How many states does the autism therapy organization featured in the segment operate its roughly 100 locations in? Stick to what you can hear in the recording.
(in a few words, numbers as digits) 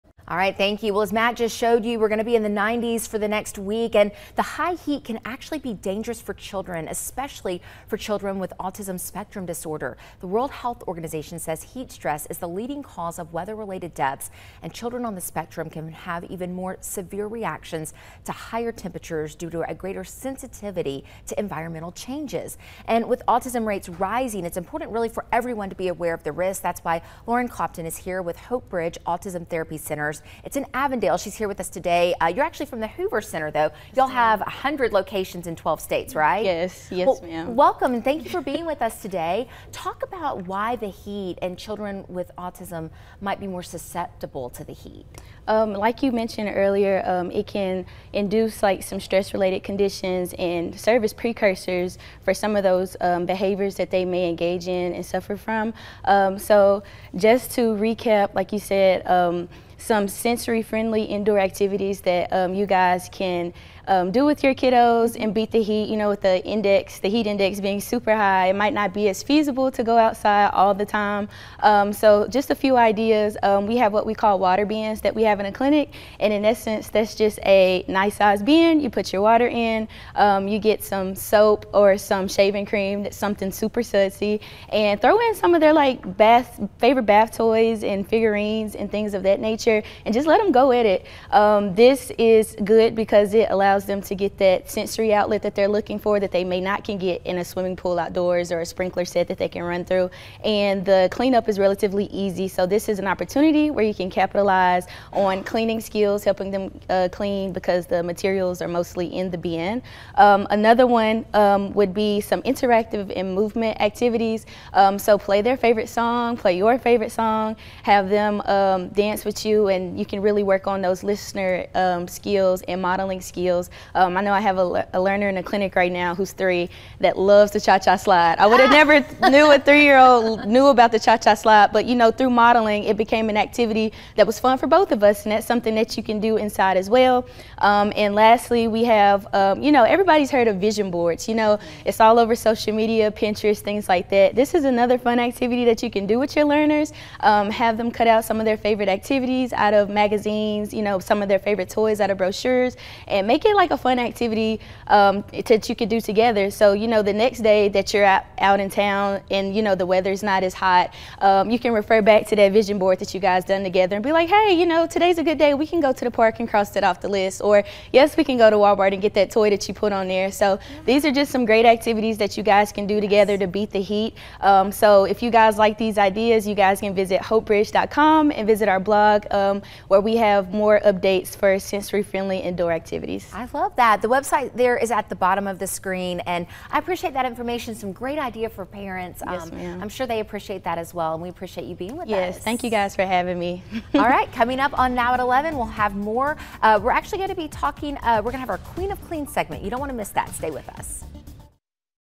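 12.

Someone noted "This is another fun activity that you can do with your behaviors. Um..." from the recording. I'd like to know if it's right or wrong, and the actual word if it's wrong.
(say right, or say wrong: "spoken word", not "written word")
wrong: "learners", not "behaviors".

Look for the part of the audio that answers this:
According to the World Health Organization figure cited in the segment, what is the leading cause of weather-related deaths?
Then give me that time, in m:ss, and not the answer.
0:11.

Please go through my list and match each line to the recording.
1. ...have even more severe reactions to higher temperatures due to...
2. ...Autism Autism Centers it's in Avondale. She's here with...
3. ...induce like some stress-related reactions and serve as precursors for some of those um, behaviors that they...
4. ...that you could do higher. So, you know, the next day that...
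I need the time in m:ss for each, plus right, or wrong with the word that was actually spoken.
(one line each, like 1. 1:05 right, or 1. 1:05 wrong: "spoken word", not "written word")
1. 0:15 right
2. 0:29 wrong: "Therapy", not "Autism"
3. 0:48 wrong: "conditions", not "reactions"
4. 2:35 wrong: "together", not "higher".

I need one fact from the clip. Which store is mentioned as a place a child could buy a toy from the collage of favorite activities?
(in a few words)
Walmart.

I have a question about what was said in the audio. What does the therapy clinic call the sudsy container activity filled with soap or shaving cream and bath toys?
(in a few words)
Water bins.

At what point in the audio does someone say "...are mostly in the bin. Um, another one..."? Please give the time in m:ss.
1:48.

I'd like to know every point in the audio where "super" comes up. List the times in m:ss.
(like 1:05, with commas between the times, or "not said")
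1:07, 1:23.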